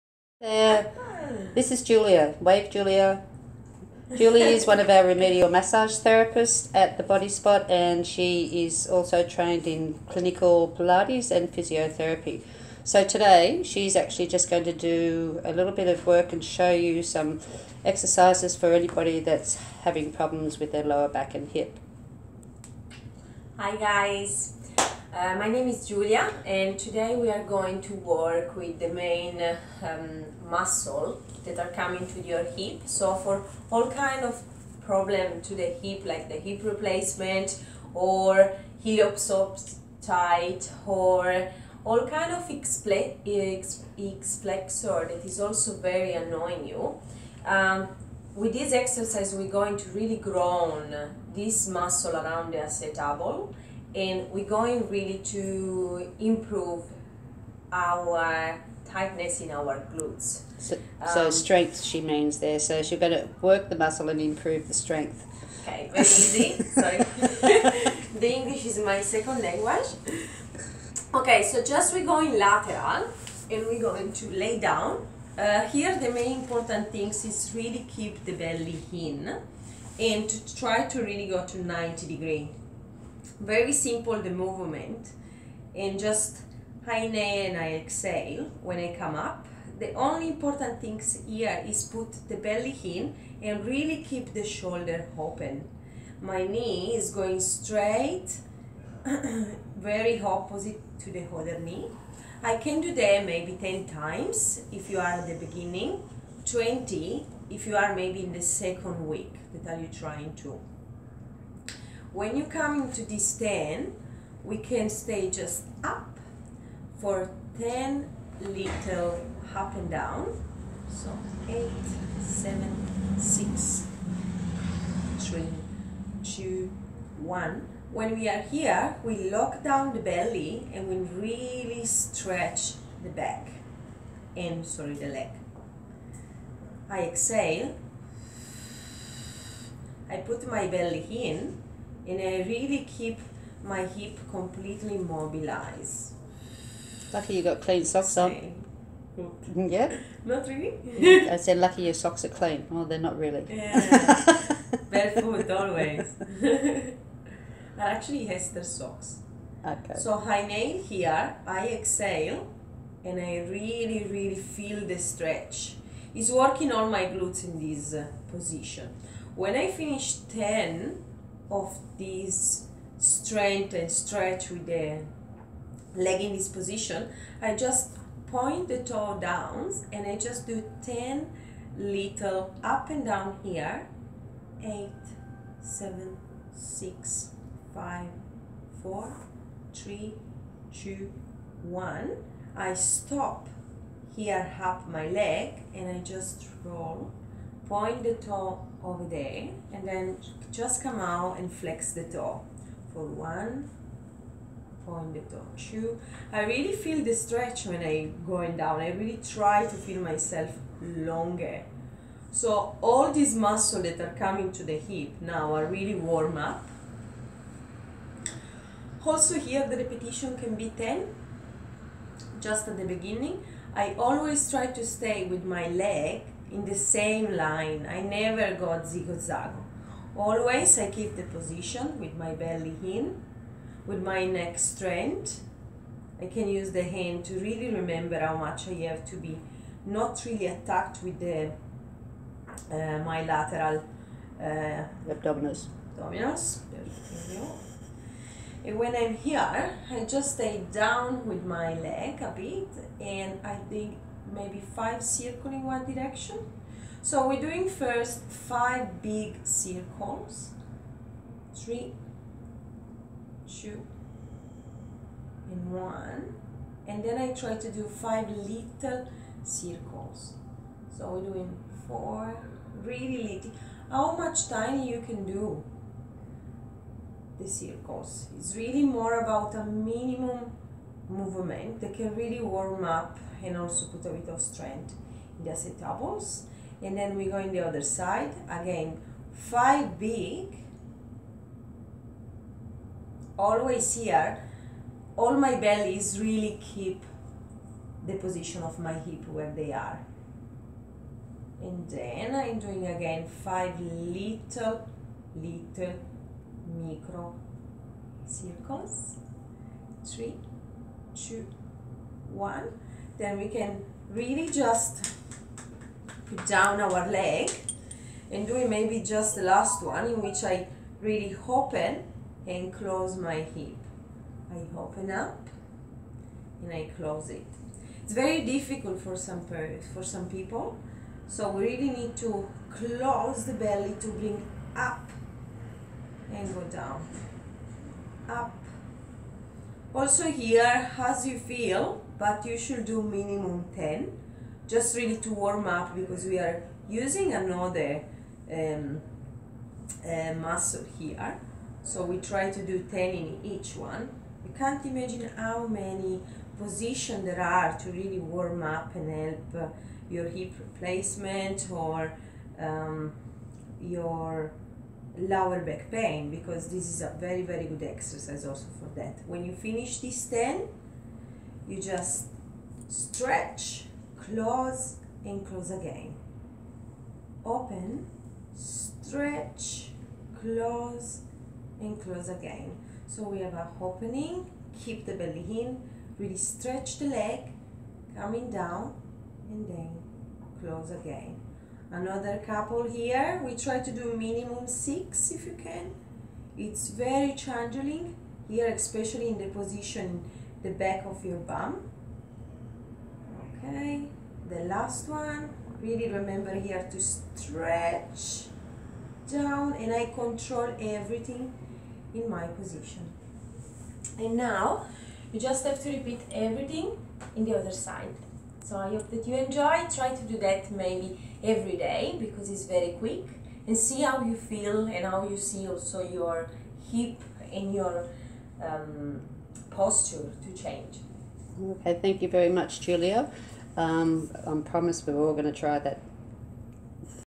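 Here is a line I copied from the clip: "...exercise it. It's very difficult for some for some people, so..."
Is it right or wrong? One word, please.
wrong.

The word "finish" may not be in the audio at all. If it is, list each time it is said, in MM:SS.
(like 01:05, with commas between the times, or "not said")
02:49, 06:09.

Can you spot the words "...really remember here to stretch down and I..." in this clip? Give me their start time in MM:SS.
06:45.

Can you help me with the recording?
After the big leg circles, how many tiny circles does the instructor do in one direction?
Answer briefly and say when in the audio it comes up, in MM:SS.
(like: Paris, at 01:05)
5, at 04:27.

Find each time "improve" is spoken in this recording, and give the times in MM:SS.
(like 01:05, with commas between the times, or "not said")
00:56, 01:04.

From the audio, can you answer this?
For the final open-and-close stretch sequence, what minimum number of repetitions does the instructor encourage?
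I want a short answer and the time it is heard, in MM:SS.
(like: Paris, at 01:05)
6, at 06:34.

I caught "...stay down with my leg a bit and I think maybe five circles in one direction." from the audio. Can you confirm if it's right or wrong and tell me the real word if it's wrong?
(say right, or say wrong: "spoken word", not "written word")
right.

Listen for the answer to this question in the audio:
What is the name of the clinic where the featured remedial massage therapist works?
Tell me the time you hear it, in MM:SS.
00:06.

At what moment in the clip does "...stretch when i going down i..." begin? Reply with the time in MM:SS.
03:27.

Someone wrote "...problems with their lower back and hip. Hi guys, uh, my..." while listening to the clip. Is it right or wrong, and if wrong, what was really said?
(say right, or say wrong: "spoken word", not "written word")
right.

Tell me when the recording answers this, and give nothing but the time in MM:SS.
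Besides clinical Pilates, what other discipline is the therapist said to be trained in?
00:11.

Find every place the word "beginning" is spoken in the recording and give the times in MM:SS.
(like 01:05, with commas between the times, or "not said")
01:45, 03:42.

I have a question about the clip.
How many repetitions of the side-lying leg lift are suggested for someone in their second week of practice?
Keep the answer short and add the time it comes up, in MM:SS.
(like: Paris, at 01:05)
20, at 01:46.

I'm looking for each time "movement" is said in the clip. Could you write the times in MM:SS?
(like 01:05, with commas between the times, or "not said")
01:24, 04:41.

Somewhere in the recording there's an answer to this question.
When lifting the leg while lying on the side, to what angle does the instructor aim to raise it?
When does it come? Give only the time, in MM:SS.
01:21.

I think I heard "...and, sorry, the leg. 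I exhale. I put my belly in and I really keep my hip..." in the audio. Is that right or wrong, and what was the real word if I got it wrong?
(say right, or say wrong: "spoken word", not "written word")
right.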